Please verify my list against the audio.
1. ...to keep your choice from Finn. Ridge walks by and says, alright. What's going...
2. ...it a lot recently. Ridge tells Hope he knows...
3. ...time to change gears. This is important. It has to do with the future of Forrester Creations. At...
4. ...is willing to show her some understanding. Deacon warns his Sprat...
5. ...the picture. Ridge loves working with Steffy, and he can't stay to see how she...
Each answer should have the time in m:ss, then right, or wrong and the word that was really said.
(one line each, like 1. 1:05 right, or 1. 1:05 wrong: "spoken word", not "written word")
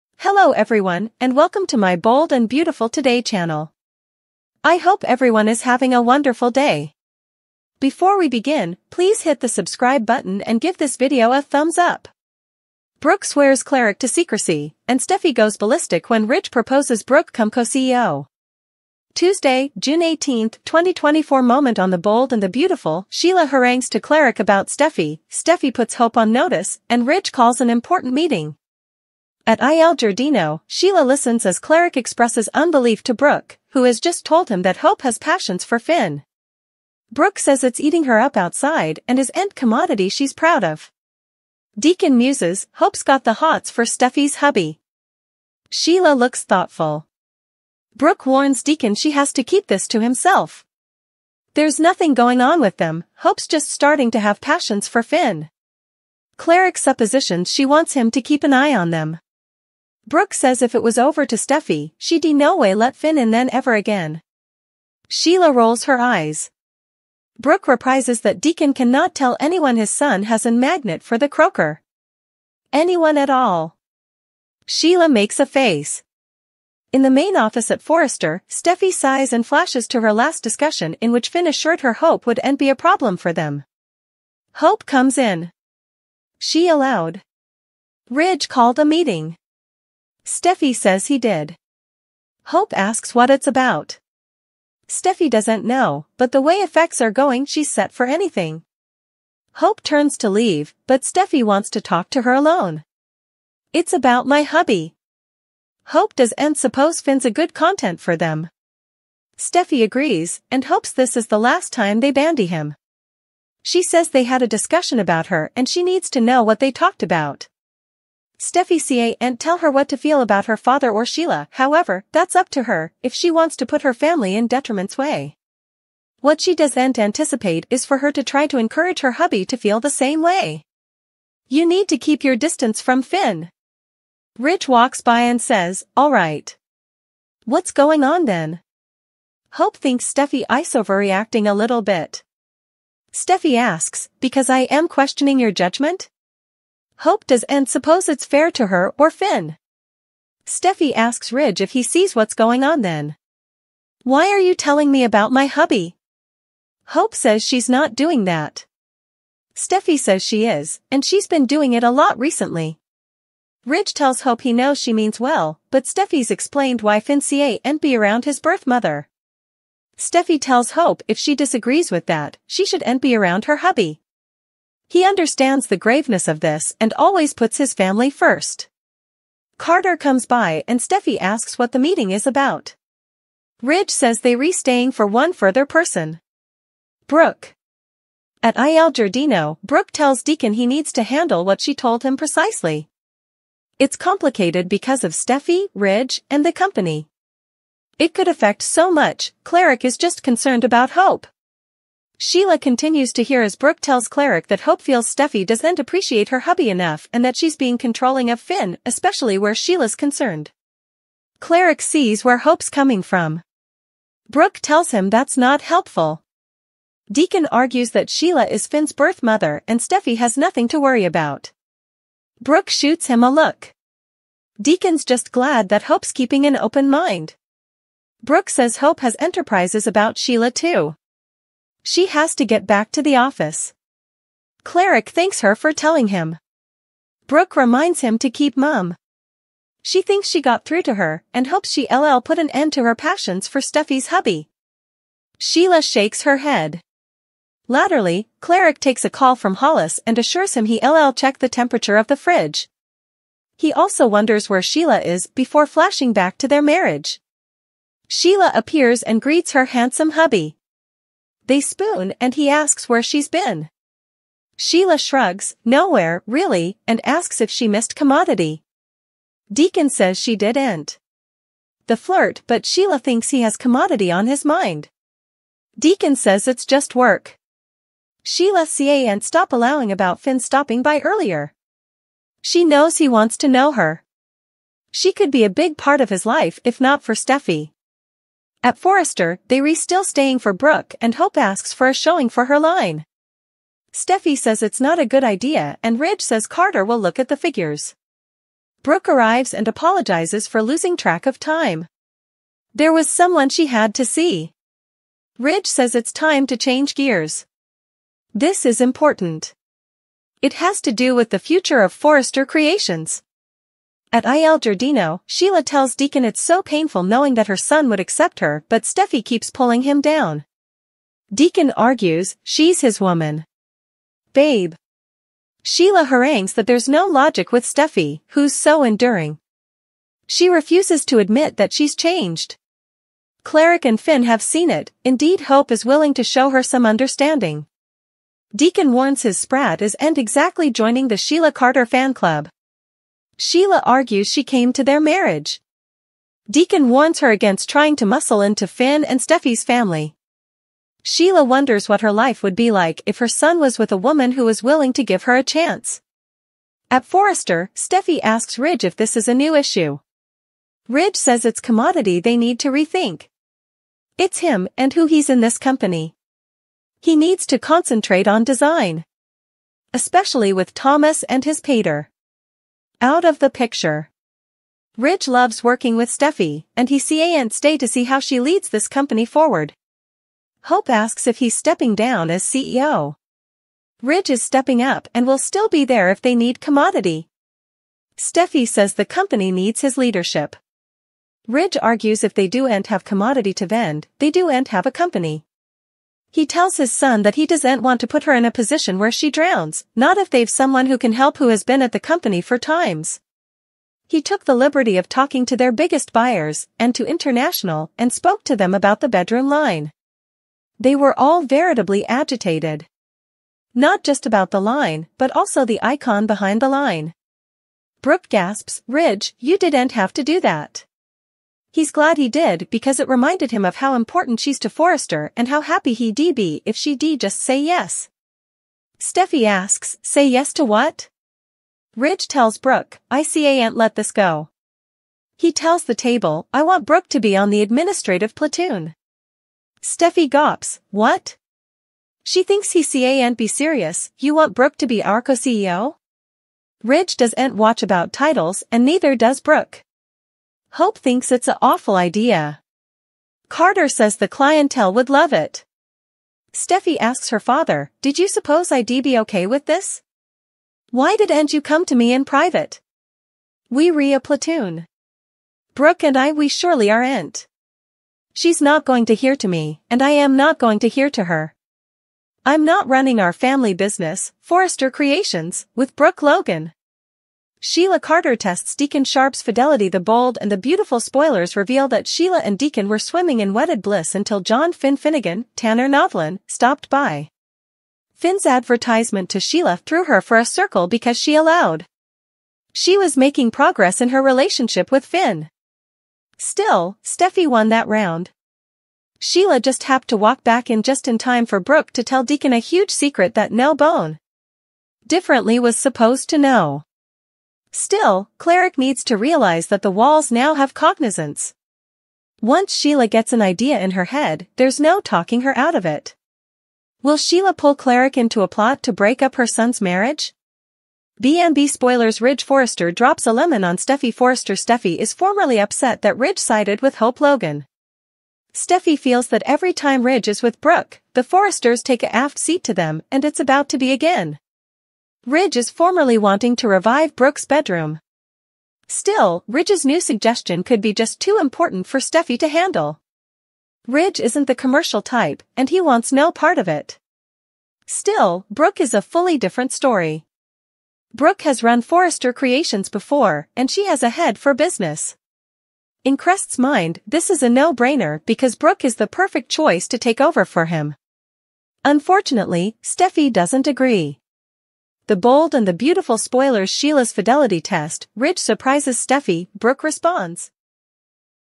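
1. 2:11 wrong: "distance", not "choice"
2. 2:41 right
3. 5:06 right
4. 5:35 right
5. 6:13 right.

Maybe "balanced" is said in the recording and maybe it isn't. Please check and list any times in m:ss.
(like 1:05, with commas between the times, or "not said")
not said.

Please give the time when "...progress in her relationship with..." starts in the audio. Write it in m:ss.
8:13.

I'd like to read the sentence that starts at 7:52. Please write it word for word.
I'm not running our family business, Forrester Creations, with Brooke Logan.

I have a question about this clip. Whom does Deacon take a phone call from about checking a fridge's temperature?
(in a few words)
Hollis.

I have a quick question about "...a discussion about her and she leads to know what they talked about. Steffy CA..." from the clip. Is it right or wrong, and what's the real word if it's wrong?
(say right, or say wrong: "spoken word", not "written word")
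wrong: "needs", not "leads".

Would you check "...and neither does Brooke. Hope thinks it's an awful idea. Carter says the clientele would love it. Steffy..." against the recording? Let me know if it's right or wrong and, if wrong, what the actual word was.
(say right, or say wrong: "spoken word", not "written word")
right.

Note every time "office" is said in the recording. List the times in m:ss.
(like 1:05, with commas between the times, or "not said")
1:17, 3:53.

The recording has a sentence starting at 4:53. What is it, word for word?
Steffy says it's not a good idea and Ridge says Carter will look at the figures.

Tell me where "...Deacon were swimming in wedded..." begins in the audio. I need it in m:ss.
8:02.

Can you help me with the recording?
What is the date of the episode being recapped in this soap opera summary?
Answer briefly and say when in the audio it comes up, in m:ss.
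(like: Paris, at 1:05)
June 18, 2024, at 0:19.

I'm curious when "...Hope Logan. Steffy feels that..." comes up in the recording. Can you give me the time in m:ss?
8:46.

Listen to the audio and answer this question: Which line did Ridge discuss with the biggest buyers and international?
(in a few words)
the bedroom line.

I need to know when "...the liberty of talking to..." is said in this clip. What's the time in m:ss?
6:44.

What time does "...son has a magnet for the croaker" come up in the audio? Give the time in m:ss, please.
1:09.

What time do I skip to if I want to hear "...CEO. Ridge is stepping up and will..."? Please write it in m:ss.
6:22.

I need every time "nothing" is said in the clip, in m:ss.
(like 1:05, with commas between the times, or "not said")
0:51, 3:40.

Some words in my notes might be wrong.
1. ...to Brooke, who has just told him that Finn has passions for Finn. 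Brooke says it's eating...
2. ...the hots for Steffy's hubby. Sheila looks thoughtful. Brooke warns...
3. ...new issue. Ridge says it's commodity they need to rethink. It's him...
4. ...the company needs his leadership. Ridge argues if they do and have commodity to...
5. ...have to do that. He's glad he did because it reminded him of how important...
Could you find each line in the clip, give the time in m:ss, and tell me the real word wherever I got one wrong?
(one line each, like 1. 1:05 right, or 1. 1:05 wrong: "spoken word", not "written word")
1. 0:33 wrong: "Hope", not "Finn"
2. 0:43 right
3. 5:59 right
4. 6:28 right
5. 6:59 right.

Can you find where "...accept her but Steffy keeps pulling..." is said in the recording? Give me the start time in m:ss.
5:18.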